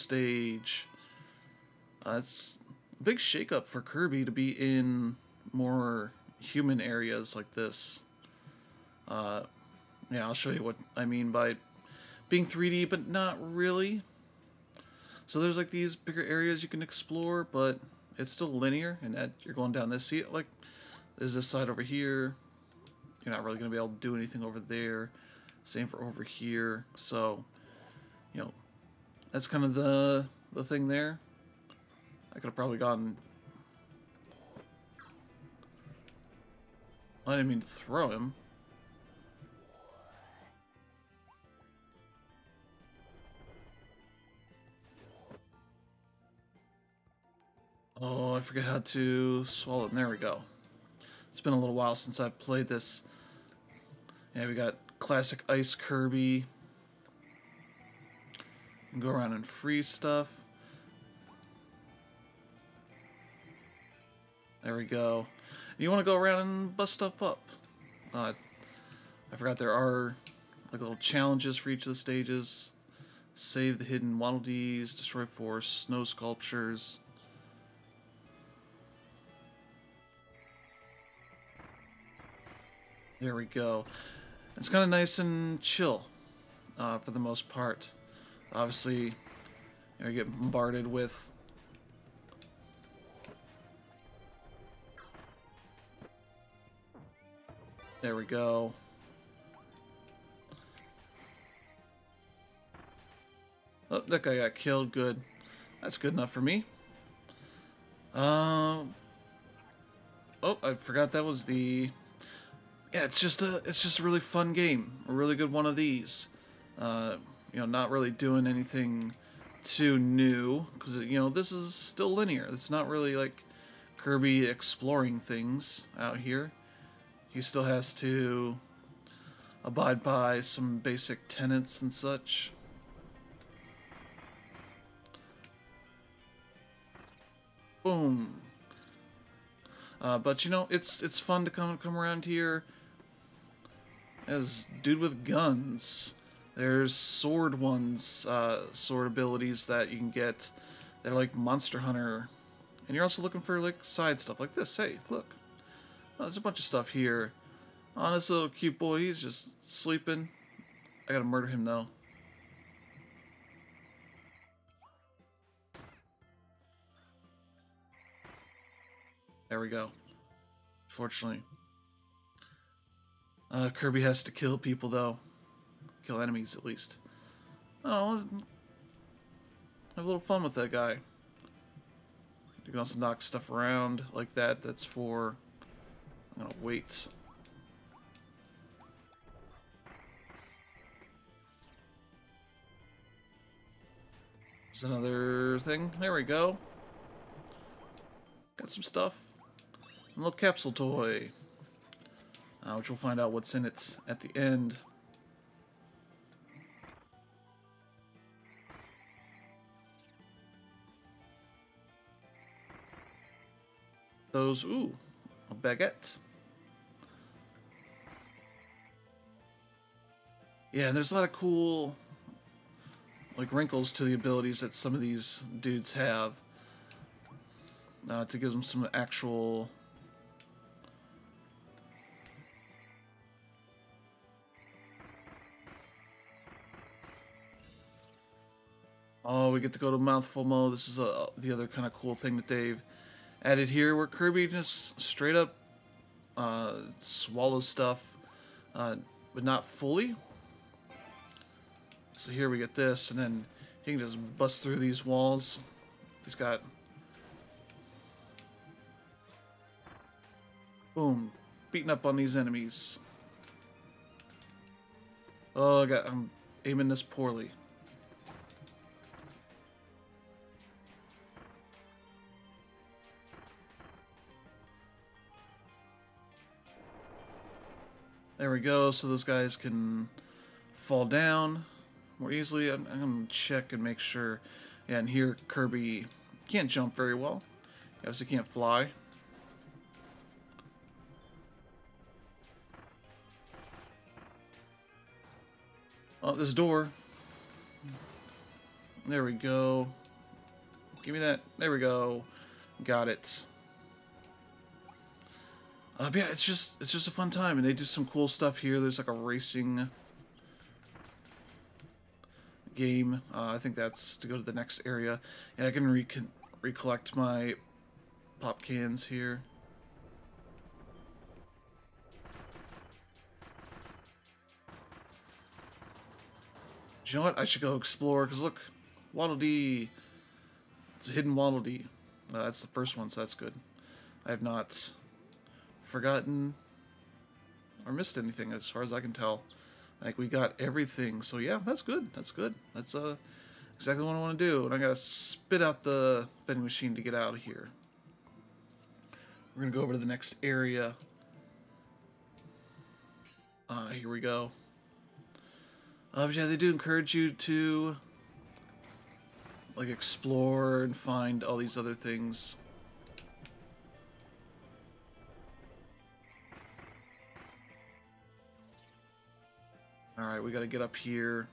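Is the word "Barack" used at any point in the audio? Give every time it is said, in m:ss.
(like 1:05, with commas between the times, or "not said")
not said.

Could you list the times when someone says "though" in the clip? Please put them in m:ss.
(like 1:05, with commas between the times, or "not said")
2:41, 2:54.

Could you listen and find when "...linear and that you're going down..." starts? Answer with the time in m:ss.
0:18.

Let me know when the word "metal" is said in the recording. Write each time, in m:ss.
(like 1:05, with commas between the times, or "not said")
not said.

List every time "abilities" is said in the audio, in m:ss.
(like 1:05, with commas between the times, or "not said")
2:29, 3:44.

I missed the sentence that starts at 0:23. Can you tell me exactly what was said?
You're not really going to be able to do anything over there.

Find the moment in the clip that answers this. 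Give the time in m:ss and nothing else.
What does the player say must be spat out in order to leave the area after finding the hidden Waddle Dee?
5:46.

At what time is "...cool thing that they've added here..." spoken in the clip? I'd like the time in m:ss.
4:01.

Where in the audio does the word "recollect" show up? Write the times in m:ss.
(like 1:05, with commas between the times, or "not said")
5:16.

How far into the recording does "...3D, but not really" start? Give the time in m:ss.
0:12.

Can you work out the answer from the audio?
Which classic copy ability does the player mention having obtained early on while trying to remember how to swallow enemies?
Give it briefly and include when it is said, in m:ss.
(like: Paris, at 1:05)
Ice Kirby, at 0:55.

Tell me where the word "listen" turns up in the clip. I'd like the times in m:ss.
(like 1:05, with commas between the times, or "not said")
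not said.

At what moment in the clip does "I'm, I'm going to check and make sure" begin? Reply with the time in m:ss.
4:42.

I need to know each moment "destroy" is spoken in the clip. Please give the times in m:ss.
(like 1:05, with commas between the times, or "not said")
1:14.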